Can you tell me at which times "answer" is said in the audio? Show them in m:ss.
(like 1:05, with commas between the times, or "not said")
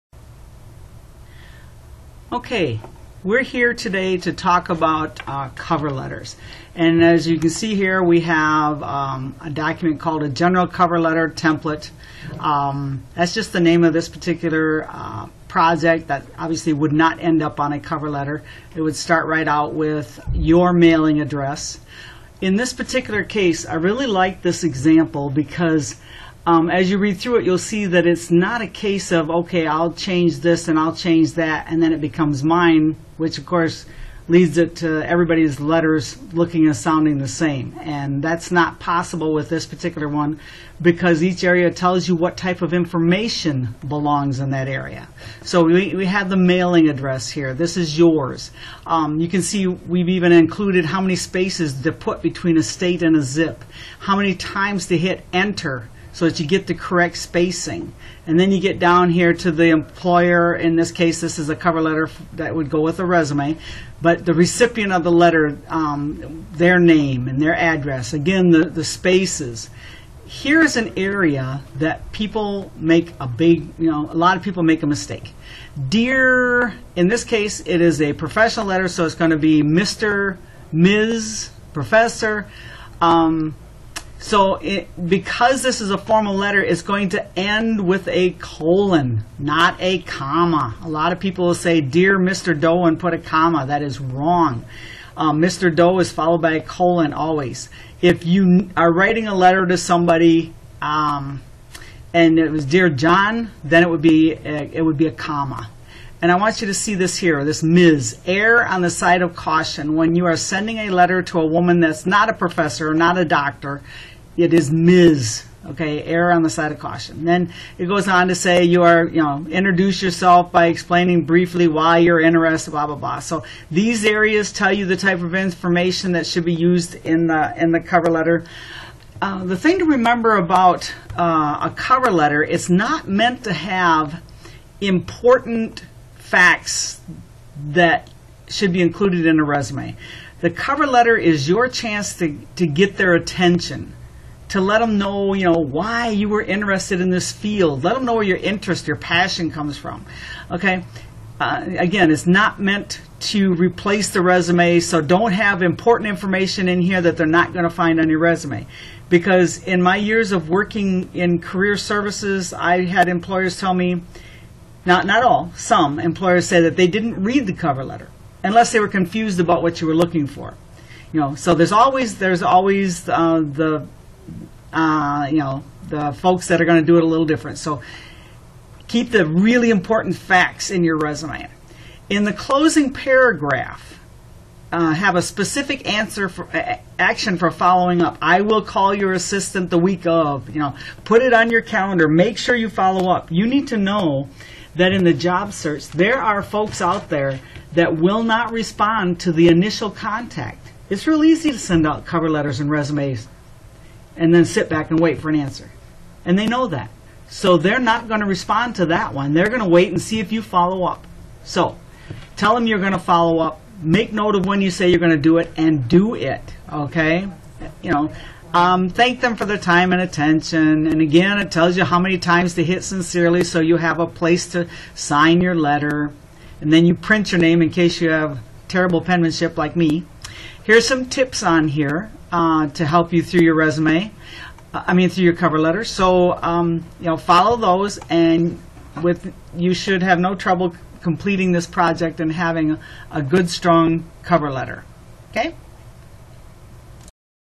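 3:05, 3:25.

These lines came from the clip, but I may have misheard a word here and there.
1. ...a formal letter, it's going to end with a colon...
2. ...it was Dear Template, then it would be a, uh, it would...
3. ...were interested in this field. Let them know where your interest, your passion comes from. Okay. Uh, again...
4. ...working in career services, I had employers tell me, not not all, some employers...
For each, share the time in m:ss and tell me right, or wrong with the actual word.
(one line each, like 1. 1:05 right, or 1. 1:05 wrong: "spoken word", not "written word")
1. 1:25 right
2. 1:42 wrong: "John", not "Template"
3. 2:26 right
4. 2:40 right.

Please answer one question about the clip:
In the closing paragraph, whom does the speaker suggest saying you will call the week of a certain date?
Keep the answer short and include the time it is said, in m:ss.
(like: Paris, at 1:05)
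your assistant, at 3:08.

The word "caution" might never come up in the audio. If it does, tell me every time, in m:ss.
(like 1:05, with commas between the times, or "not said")
1:49, 1:56.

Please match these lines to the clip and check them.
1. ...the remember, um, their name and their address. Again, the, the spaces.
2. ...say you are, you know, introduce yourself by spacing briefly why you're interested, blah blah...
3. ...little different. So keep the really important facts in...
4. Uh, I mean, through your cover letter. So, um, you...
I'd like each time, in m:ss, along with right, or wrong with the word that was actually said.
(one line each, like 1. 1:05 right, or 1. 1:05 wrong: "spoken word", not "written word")
1. 1:05 wrong: "letter", not "remember"
2. 1:58 wrong: "explaining", not "spacing"
3. 2:57 right
4. 3:54 right.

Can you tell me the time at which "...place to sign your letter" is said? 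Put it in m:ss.
3:44.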